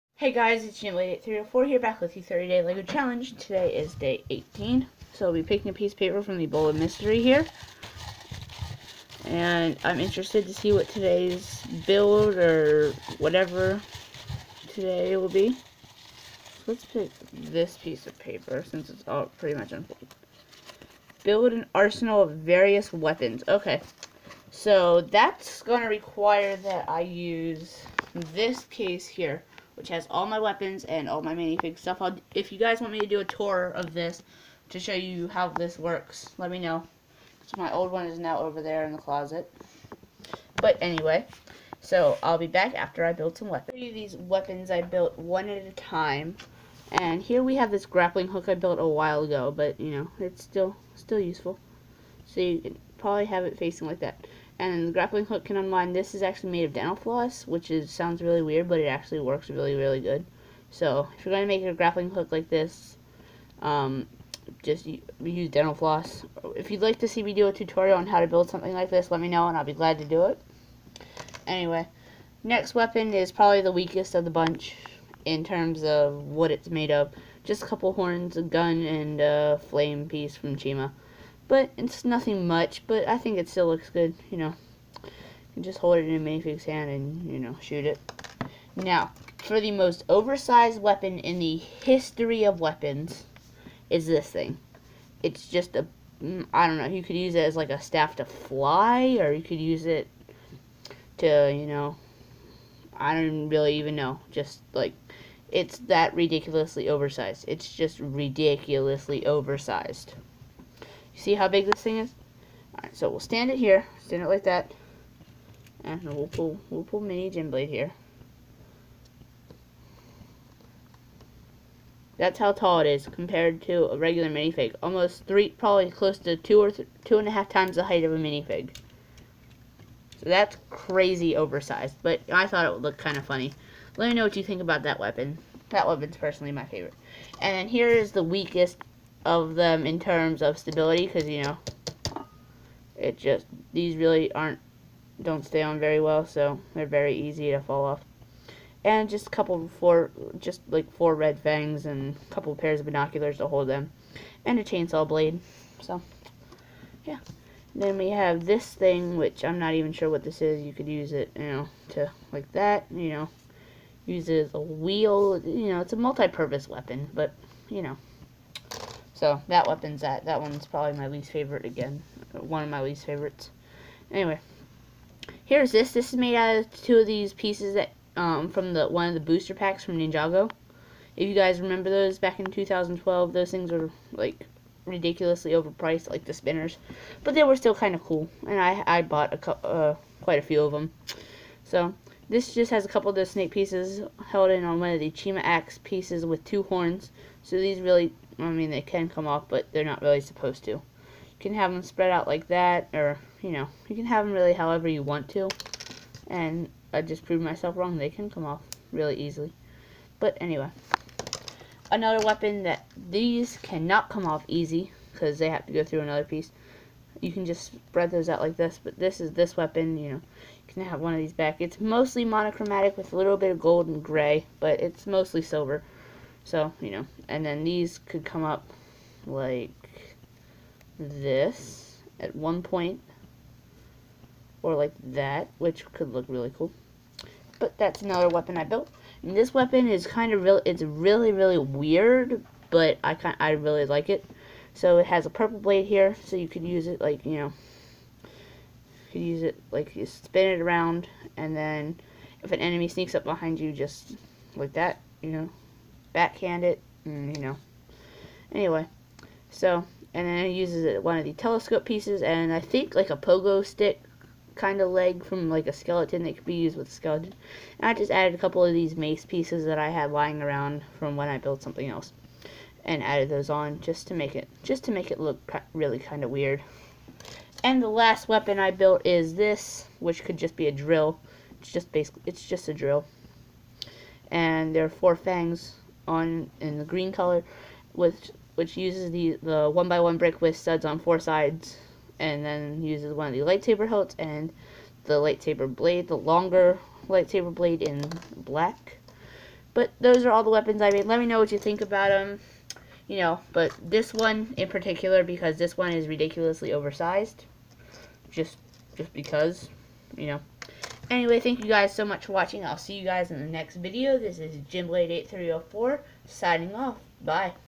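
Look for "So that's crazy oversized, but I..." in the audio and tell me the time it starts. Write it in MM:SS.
02:10.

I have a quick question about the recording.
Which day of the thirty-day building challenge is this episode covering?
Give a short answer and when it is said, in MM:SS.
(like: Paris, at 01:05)
18, at 00:03.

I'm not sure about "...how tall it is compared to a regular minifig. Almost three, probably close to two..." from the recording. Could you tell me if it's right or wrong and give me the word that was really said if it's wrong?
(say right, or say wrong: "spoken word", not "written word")
right.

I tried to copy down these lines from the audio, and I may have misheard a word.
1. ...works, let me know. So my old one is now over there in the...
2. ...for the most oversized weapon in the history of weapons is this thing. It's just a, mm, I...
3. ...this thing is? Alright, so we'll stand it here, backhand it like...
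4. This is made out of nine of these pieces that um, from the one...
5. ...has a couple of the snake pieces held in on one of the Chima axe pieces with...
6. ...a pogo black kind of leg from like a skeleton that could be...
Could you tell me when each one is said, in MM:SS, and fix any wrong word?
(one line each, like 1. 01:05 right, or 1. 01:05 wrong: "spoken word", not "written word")
1. 00:35 right
2. 01:29 right
3. 01:51 wrong: "stand", not "backhand"
4. 02:55 wrong: "two", not "nine"
5. 03:12 right
6. 04:23 wrong: "stick", not "black".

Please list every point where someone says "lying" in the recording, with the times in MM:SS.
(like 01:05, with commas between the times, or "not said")
04:30.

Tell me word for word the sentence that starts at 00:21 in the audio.
Build an arsenal of various weapons.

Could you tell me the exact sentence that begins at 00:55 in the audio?
This is actually made of dental floss, which is sounds really weird, but it actually works really, really good.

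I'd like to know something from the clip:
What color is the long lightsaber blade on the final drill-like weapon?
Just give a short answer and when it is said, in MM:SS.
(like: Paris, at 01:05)
Black, at 04:58.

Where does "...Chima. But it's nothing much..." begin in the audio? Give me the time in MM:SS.
01:20.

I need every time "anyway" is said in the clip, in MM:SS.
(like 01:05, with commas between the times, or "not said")
00:40, 01:11, 02:54, 03:30, 04:18, 05:11.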